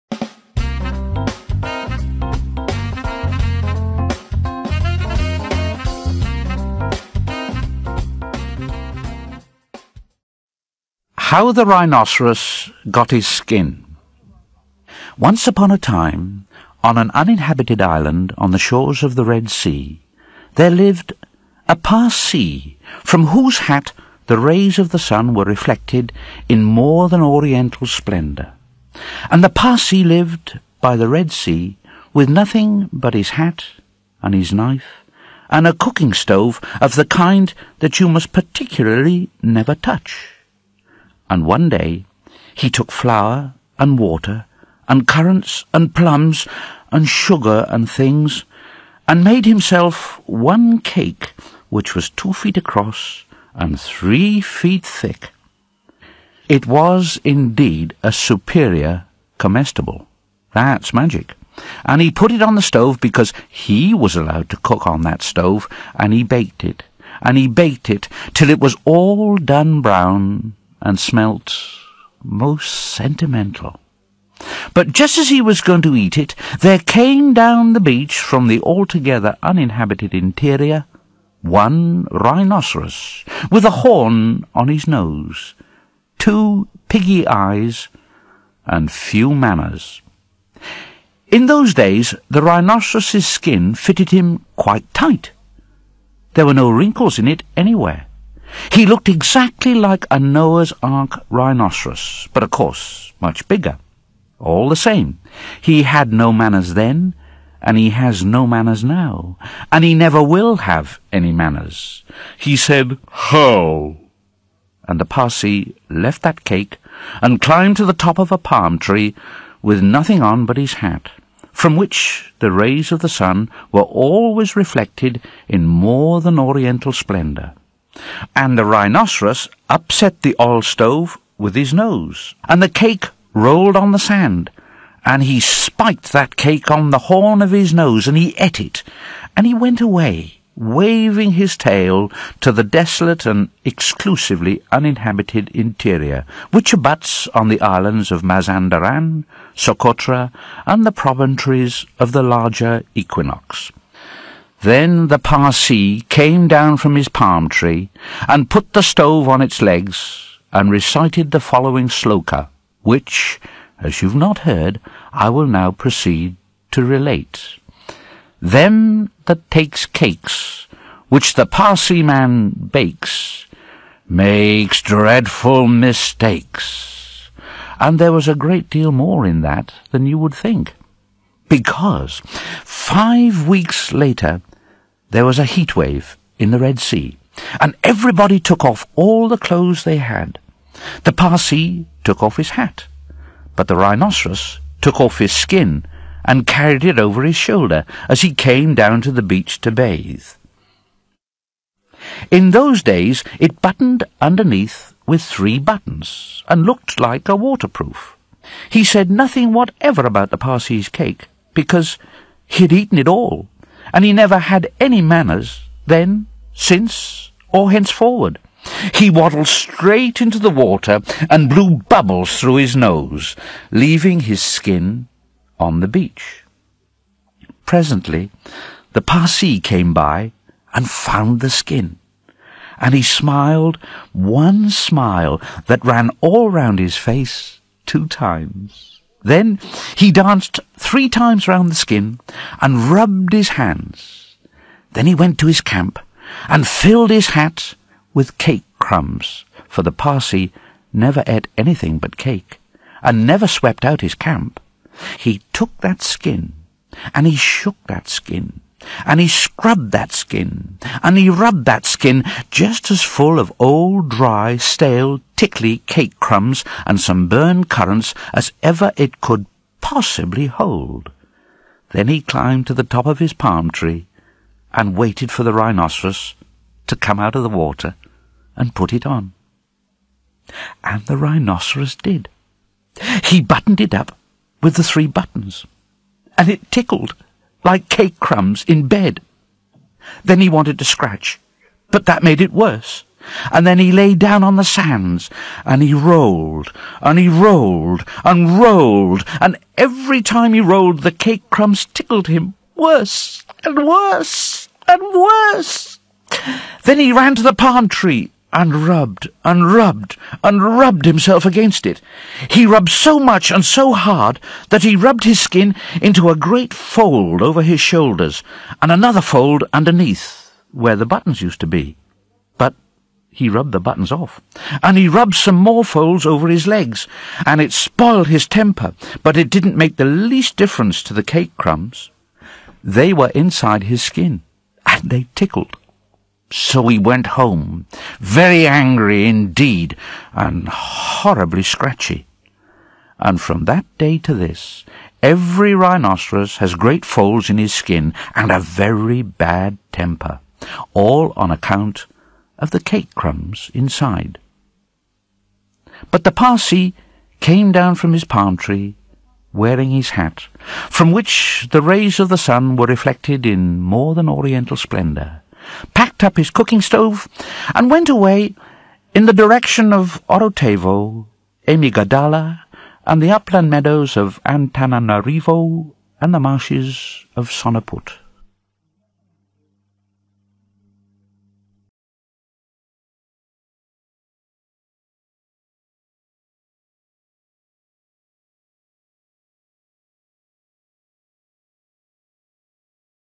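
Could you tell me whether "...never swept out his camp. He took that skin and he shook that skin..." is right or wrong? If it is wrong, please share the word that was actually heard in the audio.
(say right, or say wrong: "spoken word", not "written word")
right.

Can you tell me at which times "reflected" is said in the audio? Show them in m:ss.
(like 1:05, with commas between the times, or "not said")
0:25, 2:04, 6:02.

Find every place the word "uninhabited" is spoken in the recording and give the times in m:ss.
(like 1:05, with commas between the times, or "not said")
0:17, 1:19, 2:24.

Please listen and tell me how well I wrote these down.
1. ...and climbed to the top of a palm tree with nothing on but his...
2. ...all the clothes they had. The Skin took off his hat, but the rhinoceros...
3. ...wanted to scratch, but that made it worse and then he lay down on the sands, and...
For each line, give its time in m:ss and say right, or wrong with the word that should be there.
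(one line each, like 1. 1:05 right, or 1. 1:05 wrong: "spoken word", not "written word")
1. 1:57 right
2. 3:08 wrong: "Parsee", not "Skin"
3. 4:50 right.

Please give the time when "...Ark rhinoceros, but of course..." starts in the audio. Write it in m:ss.
1:40.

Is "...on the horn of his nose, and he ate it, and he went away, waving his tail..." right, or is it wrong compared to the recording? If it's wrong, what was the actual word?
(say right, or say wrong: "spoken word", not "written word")
right.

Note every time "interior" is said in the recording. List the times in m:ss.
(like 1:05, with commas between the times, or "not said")
1:20, 2:25.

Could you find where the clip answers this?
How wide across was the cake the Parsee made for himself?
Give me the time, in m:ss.
0:52.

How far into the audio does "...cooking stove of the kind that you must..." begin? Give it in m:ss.
0:35.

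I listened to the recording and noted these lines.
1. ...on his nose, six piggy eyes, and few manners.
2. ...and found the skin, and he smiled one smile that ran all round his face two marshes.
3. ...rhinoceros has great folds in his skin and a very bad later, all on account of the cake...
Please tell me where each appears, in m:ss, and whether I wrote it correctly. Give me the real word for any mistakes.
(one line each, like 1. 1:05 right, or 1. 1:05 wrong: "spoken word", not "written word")
1. 1:24 wrong: "two", not "six"
2. 3:50 wrong: "times", not "marshes"
3. 5:45 wrong: "temper", not "later".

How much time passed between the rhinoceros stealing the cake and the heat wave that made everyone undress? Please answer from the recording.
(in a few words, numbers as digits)
5 weeks.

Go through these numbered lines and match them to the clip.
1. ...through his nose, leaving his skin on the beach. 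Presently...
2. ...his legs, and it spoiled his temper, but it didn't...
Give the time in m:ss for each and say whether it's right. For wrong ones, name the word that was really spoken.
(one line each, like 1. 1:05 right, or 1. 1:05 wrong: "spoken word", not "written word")
1. 3:42 right
2. 5:26 right.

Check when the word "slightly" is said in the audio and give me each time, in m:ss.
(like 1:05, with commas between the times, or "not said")
not said.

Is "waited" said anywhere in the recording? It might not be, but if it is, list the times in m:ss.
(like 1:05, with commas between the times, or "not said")
4:34.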